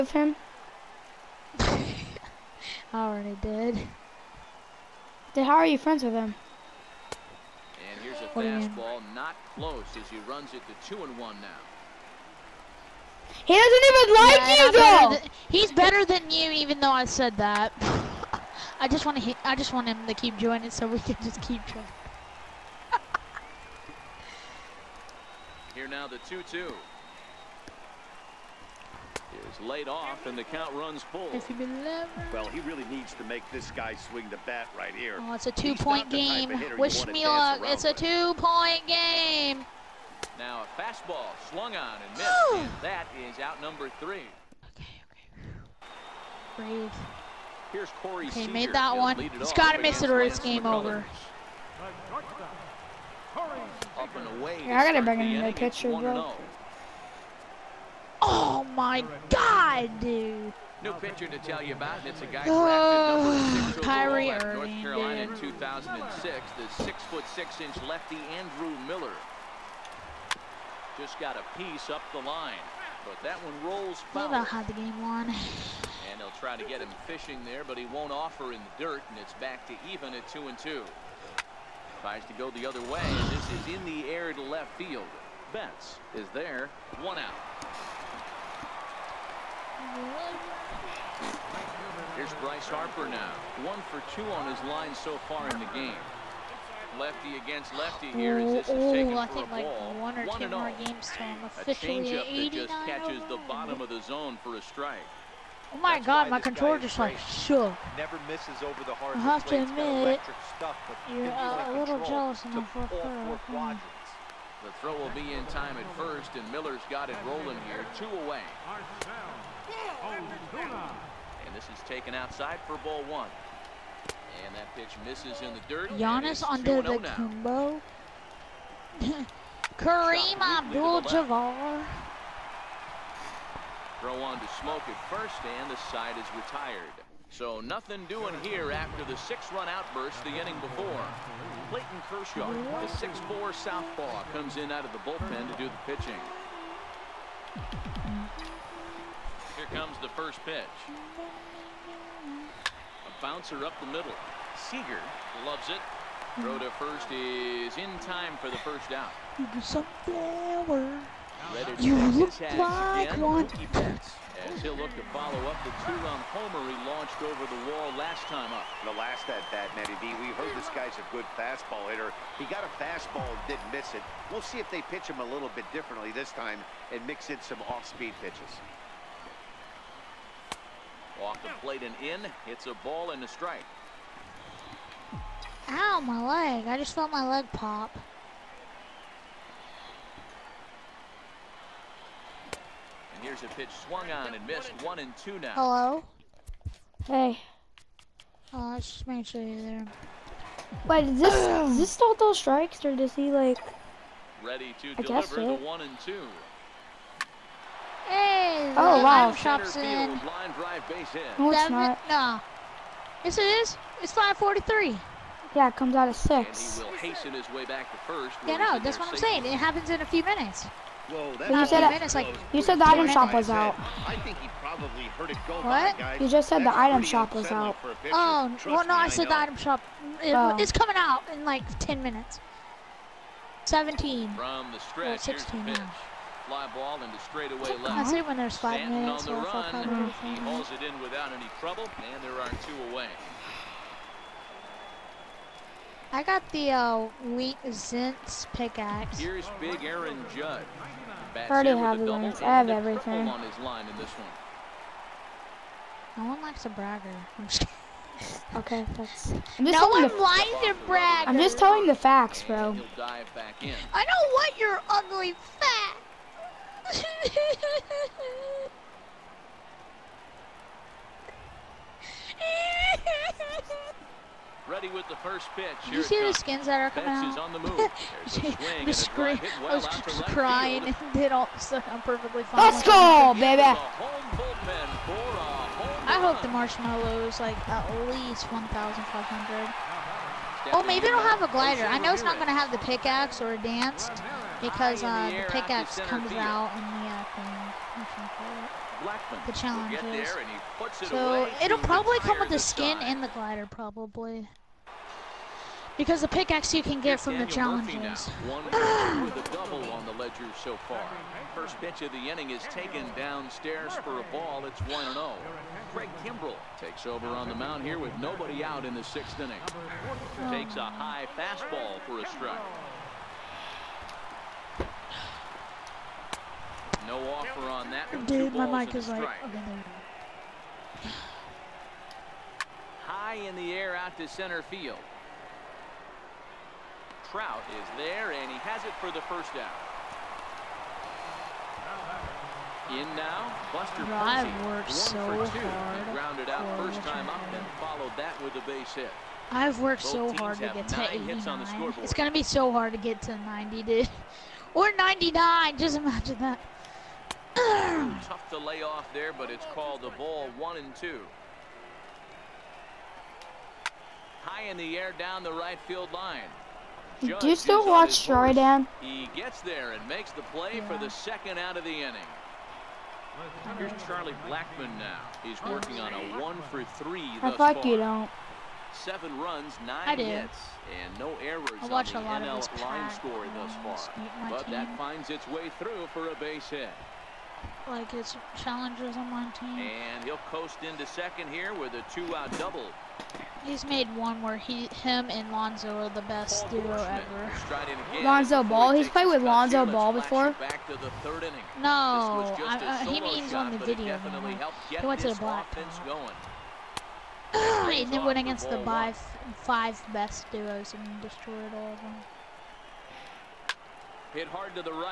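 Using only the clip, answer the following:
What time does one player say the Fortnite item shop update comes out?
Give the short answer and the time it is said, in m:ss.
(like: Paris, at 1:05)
6, at 3:36.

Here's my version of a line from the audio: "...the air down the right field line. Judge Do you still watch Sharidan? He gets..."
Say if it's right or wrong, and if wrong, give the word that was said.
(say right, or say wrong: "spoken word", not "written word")
right.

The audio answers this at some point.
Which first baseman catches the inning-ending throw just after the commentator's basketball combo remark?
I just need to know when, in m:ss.
2:14.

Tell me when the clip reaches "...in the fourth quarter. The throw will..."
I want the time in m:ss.
1:52.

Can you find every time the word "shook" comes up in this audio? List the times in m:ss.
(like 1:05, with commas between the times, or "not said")
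1:47.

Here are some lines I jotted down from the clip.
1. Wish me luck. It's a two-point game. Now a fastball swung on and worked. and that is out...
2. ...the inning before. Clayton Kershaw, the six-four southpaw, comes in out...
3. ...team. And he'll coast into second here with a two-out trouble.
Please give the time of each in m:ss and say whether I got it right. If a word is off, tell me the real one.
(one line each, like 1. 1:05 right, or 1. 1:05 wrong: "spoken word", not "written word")
1. 0:36 wrong: "missed", not "worked"
2. 2:20 right
3. 6:29 wrong: "double", not "trouble".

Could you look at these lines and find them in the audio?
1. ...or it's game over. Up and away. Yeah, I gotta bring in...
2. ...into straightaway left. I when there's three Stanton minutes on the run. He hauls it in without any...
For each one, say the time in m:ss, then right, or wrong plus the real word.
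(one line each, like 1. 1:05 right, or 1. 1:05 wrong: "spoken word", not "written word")
1. 0:50 right
2. 3:57 wrong: "five", not "three".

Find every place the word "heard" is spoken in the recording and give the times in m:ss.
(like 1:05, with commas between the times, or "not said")
2:50, 3:45.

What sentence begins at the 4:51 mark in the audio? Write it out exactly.
I know it's not going to have the pickaxe or a dance, because uh, the, pickaxe comes field.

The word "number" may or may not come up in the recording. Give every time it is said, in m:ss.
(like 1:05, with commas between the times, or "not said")
0:43, 1:03.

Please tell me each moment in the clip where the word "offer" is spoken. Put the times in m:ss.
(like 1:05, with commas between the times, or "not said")
1:18, 5:27.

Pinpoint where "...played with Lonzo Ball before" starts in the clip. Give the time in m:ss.
6:39.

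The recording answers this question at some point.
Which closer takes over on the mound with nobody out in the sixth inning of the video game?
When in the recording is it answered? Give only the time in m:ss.
5:15.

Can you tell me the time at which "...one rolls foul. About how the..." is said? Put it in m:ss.
1:13.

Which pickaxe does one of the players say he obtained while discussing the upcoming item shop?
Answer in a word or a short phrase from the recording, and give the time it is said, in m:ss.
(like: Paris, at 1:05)
Wheat Zintz, at 4:07.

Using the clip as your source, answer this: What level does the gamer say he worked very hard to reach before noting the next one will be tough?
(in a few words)
89.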